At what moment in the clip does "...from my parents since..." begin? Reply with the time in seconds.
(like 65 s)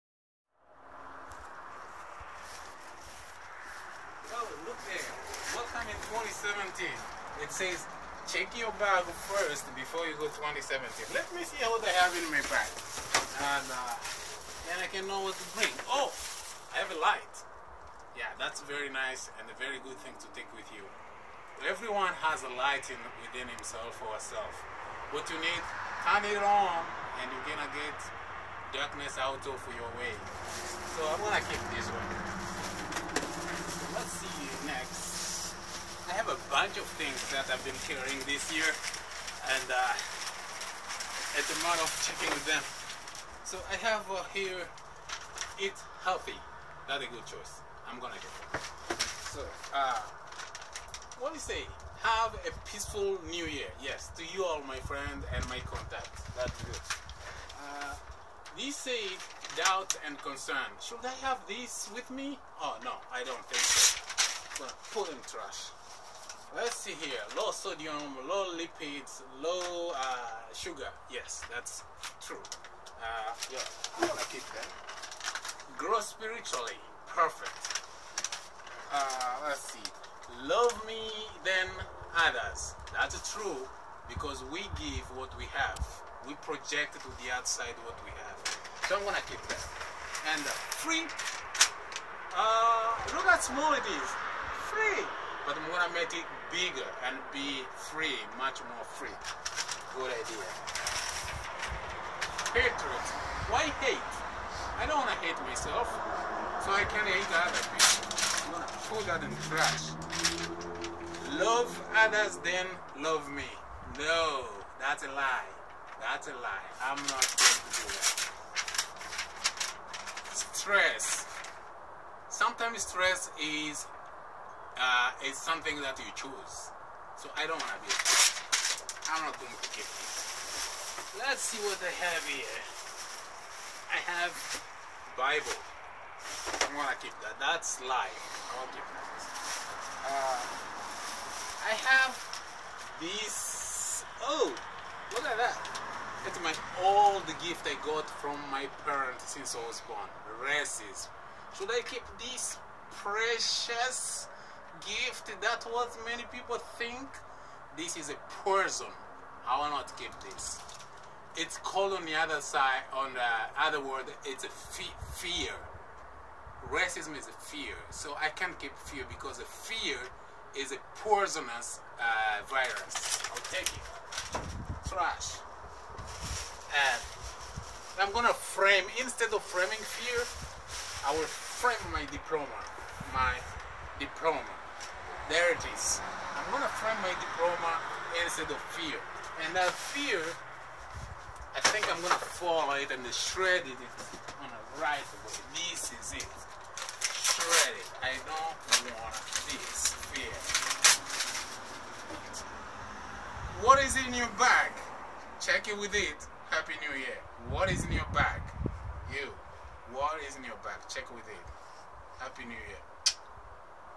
148 s.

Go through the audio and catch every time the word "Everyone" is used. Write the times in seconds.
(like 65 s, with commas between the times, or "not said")
21 s.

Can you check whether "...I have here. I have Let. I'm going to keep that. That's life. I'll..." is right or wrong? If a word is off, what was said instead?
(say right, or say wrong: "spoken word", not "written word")
wrong: "Bible", not "Let".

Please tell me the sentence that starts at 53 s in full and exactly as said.
Yes, to you all, my friend, and my contacts.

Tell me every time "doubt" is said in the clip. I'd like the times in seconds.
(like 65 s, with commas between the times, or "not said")
59 s.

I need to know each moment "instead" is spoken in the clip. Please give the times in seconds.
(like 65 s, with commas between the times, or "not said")
178 s, 188 s.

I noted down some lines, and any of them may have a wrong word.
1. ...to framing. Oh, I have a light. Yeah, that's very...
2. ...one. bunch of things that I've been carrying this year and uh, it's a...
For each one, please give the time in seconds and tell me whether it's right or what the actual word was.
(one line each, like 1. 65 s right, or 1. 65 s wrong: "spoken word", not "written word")
1. 15 s wrong: "bring", not "framing"
2. 31 s right.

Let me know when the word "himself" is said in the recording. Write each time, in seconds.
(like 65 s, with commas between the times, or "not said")
23 s.